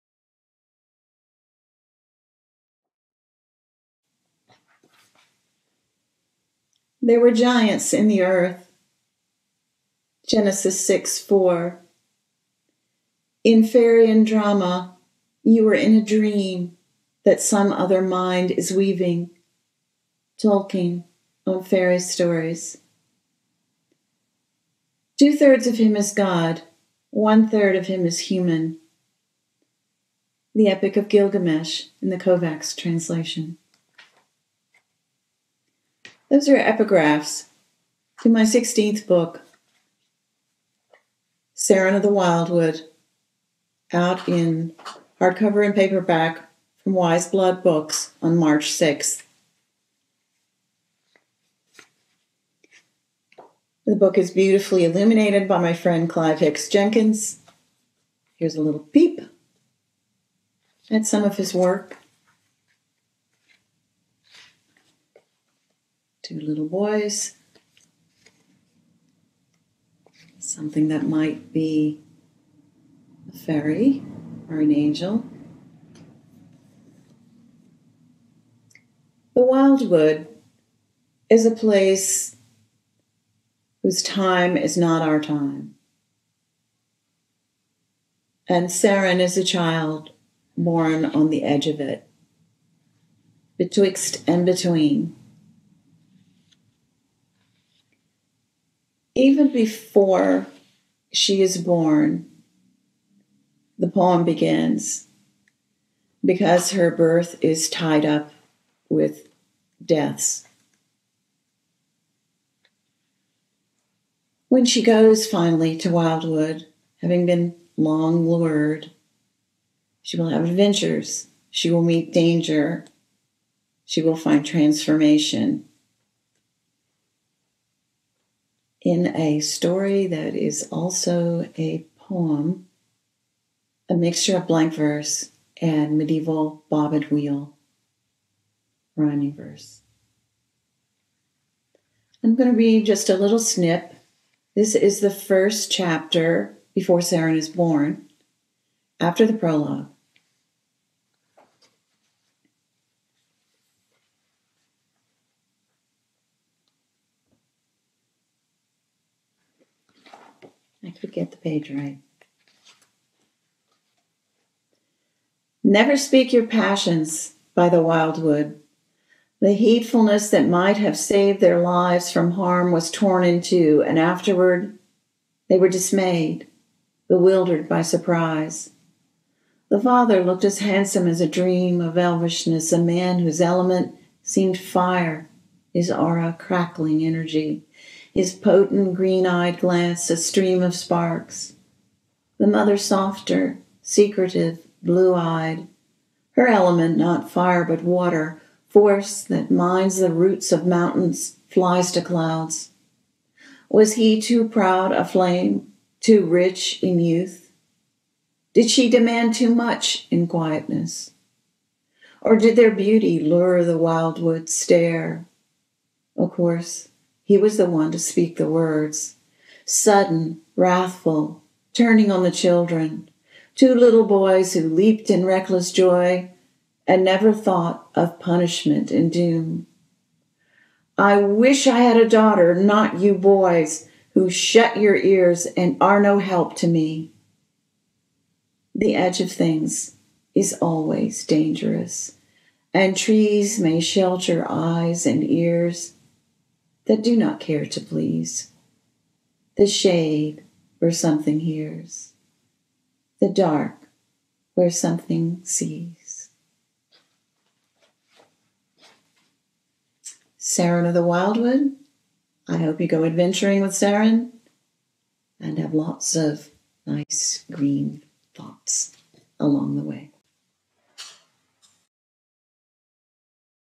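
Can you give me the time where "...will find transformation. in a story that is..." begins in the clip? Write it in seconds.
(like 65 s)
124 s.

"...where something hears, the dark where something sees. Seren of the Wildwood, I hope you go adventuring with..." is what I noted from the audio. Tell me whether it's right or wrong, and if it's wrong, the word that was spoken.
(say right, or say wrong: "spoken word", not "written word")
right.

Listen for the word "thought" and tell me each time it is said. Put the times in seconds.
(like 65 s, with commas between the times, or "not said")
227 s, 268 s.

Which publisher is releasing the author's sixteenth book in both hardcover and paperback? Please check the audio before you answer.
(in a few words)
Wiseblood Books.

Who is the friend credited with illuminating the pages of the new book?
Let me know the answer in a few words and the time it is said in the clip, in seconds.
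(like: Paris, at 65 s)
Clive Hicks Jenkins, at 56 s.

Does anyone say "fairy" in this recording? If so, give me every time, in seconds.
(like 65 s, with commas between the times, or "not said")
13 s, 21 s, 73 s.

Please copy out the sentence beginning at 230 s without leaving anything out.
I wish I had a daughter, not you boys, who shut your ears and are no help to me.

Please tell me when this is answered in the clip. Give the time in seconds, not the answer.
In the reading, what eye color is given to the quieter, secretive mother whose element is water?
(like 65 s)
194 s.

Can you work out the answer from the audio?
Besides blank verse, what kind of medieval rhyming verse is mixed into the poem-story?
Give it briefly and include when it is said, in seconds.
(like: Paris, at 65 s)
bob and wheel, at 136 s.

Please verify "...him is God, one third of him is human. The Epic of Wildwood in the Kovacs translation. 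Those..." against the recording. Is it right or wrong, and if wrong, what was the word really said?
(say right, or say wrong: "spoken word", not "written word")
wrong: "Gilgamesh", not "Wildwood".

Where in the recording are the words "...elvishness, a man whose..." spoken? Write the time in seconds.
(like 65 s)
181 s.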